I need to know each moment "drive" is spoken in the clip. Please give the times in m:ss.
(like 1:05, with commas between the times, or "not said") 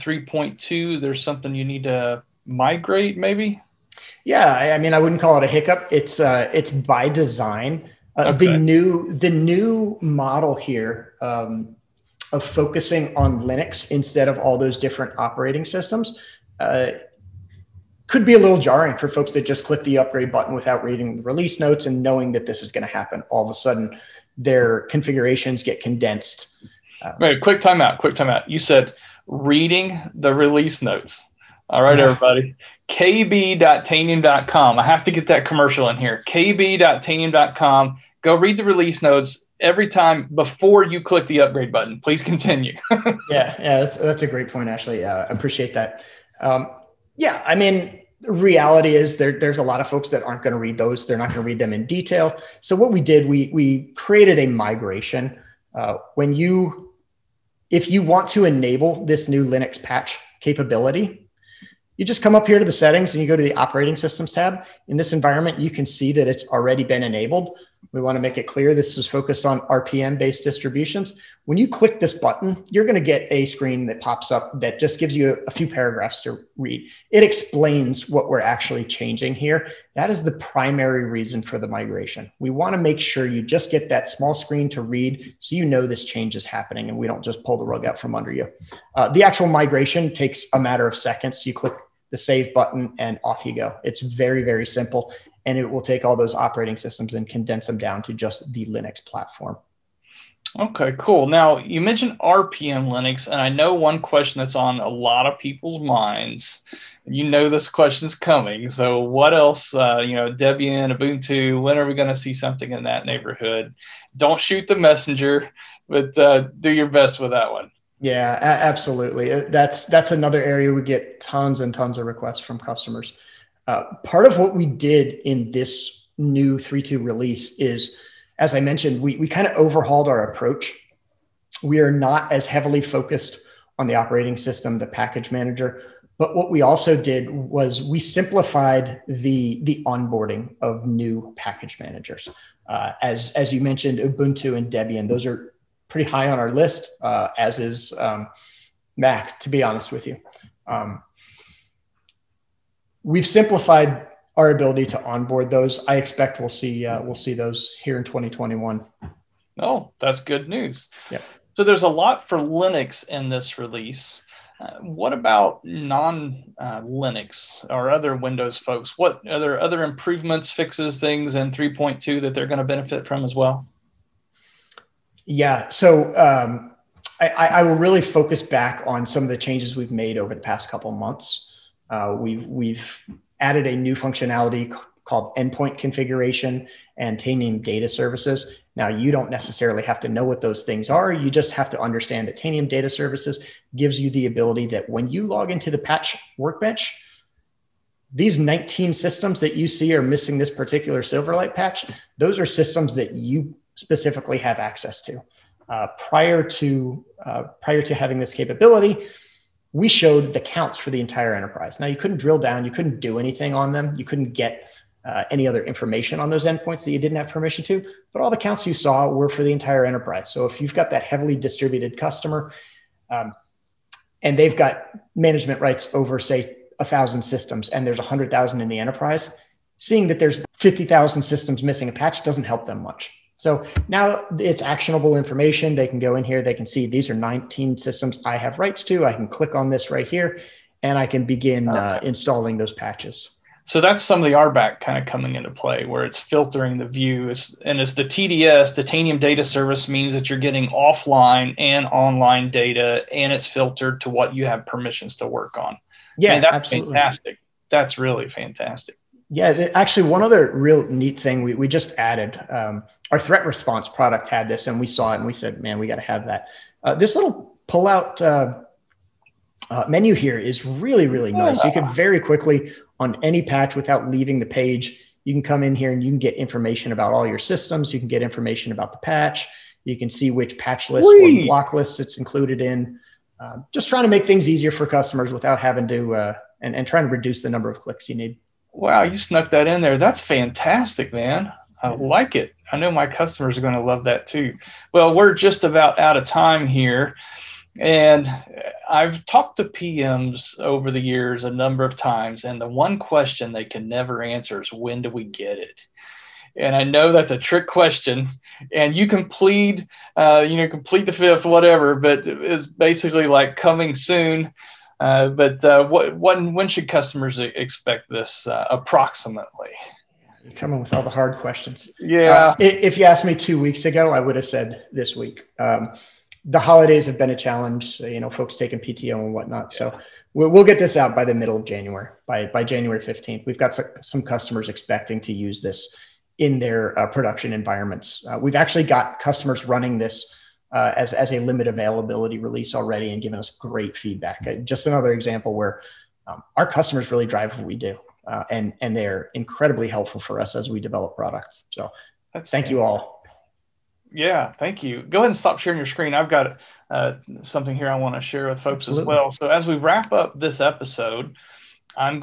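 5:47.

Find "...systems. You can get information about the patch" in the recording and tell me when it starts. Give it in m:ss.
4:37.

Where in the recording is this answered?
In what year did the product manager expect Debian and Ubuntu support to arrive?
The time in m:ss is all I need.
2:38.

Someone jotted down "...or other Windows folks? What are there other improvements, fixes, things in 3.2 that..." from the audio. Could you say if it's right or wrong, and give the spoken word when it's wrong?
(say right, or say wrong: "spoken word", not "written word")
right.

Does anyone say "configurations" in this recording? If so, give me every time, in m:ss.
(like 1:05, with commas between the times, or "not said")
0:24, 3:05.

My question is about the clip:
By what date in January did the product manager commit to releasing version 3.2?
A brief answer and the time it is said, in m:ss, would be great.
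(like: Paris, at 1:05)
January 15th, at 5:32.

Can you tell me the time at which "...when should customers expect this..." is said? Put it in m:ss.
5:16.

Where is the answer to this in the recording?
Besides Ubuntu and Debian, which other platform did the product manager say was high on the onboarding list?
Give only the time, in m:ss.
2:28.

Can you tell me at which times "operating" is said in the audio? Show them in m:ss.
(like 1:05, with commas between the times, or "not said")
0:15, 1:03, 1:36, 2:13.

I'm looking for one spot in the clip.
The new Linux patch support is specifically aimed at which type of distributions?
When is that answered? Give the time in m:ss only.
1:09.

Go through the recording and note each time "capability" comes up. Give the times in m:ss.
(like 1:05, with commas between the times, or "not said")
1:00, 3:28.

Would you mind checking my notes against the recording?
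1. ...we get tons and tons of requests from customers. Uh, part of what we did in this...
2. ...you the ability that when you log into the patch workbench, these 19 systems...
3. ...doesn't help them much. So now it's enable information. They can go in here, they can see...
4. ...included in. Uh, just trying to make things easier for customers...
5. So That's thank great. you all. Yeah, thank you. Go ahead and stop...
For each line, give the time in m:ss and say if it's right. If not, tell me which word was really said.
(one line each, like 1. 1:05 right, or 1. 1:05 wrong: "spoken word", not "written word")
1. 2:00 right
2. 3:13 right
3. 3:52 wrong: "actionable", not "enable"
4. 4:42 right
5. 5:51 right.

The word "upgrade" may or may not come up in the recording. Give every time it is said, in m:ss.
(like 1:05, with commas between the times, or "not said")
0:19, 0:41.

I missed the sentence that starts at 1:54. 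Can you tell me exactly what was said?
Don't shoot the messenger, but uh, do your best with that one.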